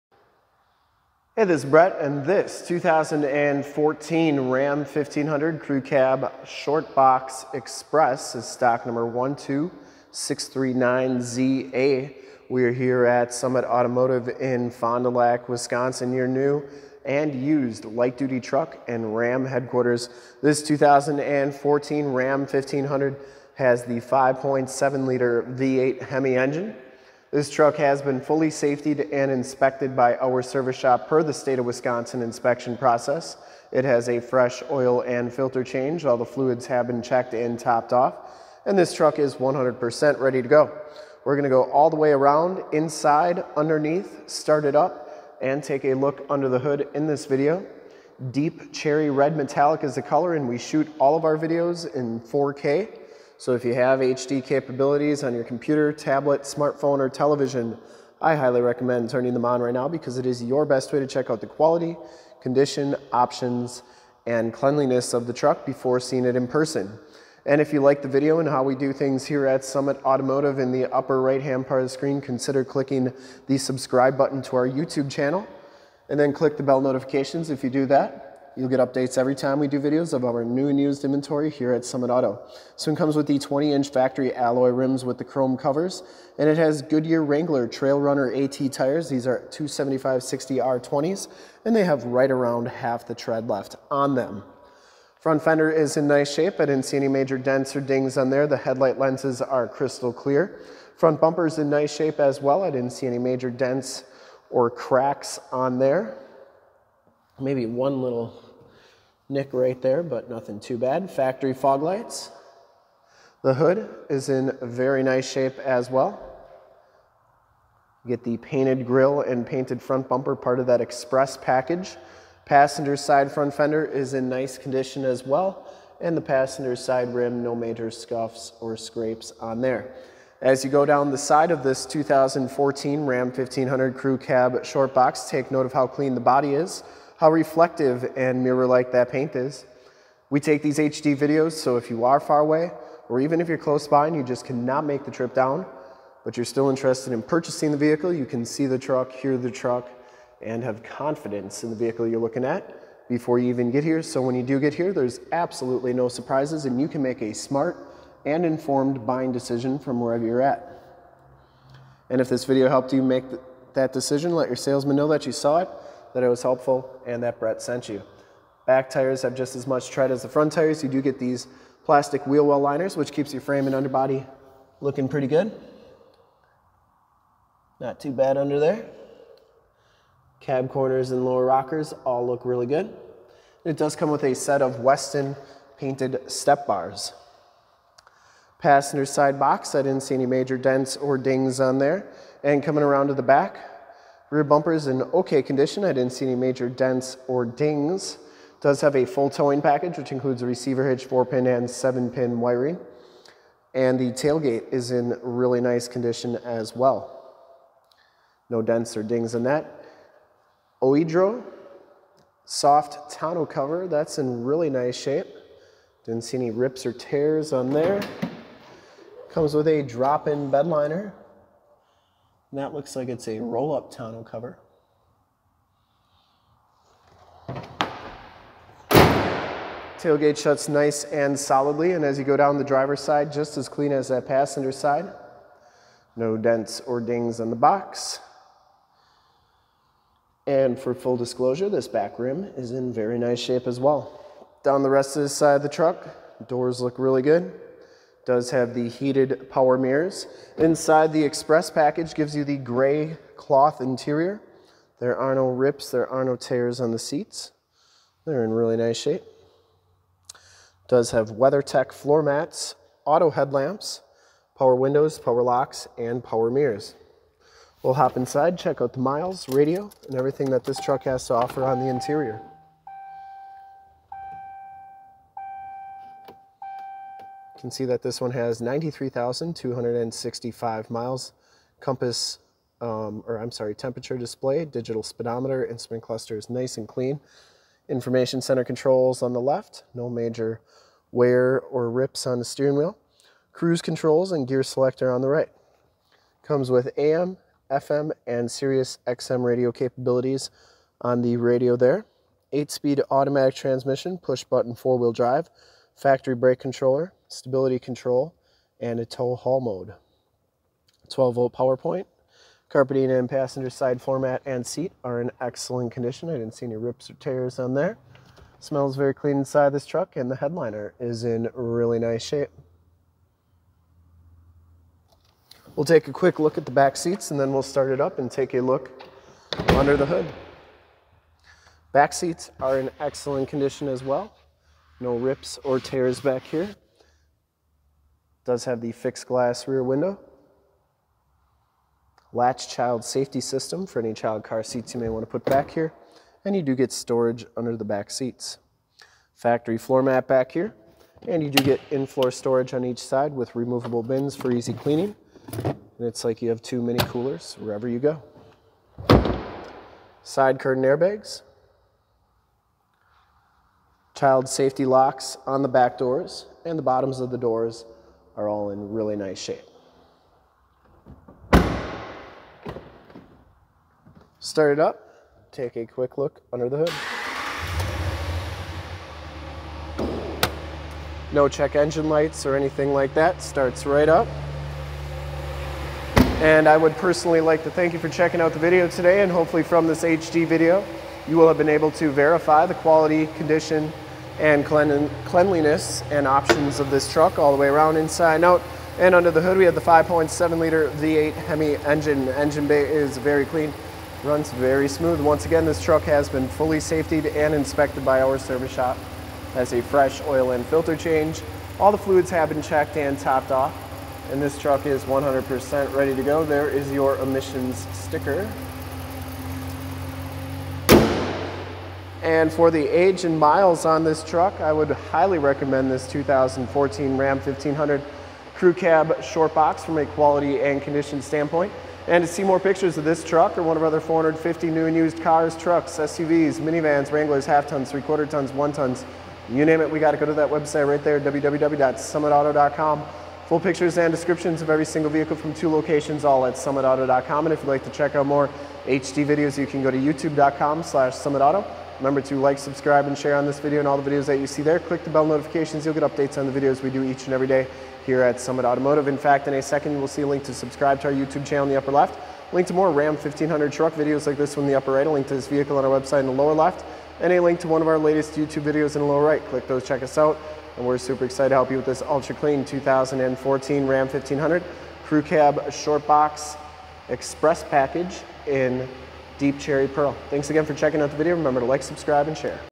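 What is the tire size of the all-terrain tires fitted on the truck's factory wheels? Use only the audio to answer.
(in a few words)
275-60R20.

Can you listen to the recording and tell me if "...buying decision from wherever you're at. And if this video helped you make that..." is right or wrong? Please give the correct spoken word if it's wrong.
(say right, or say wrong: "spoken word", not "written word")
right.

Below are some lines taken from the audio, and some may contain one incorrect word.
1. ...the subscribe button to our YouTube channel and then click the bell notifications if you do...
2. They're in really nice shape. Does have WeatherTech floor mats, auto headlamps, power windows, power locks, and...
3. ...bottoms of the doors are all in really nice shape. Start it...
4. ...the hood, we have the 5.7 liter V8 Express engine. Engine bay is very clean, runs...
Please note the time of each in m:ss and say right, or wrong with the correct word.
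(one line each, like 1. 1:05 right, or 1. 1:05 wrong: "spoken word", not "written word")
1. 1:13 right
2. 4:18 right
3. 6:06 right
4. 6:39 wrong: "Hemi", not "Express".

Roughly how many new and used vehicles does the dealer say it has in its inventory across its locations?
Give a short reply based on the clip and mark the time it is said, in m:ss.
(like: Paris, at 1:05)
450, at 7:13.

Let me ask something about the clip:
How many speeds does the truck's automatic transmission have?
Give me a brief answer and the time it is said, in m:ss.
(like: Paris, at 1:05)
8, at 5:02.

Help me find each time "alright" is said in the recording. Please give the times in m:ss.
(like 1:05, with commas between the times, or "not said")
not said.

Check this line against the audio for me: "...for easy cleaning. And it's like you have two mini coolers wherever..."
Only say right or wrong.
right.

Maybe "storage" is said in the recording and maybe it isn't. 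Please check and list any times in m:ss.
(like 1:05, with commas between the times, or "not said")
5:46, 5:52.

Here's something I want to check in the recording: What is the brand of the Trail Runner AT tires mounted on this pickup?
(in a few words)
Goodyear Wrangler.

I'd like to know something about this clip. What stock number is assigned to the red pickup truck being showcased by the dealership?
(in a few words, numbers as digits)
12639ZA.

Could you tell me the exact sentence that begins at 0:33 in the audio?
It has a fresh oil and filter change.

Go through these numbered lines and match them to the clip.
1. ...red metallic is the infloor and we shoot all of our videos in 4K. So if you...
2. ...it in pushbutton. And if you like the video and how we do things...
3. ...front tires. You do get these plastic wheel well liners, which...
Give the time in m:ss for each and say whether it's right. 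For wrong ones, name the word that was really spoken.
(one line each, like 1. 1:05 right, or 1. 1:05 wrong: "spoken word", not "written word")
1. 0:49 wrong: "color", not "infloor"
2. 1:06 wrong: "person", not "pushbutton"
3. 2:50 right.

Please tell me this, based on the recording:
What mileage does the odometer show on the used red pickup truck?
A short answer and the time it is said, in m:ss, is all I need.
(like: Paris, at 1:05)
93,265, at 4:38.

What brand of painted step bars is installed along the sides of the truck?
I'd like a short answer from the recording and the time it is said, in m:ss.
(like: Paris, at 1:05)
Westin, at 3:04.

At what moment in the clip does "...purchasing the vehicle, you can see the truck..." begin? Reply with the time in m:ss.
2:27.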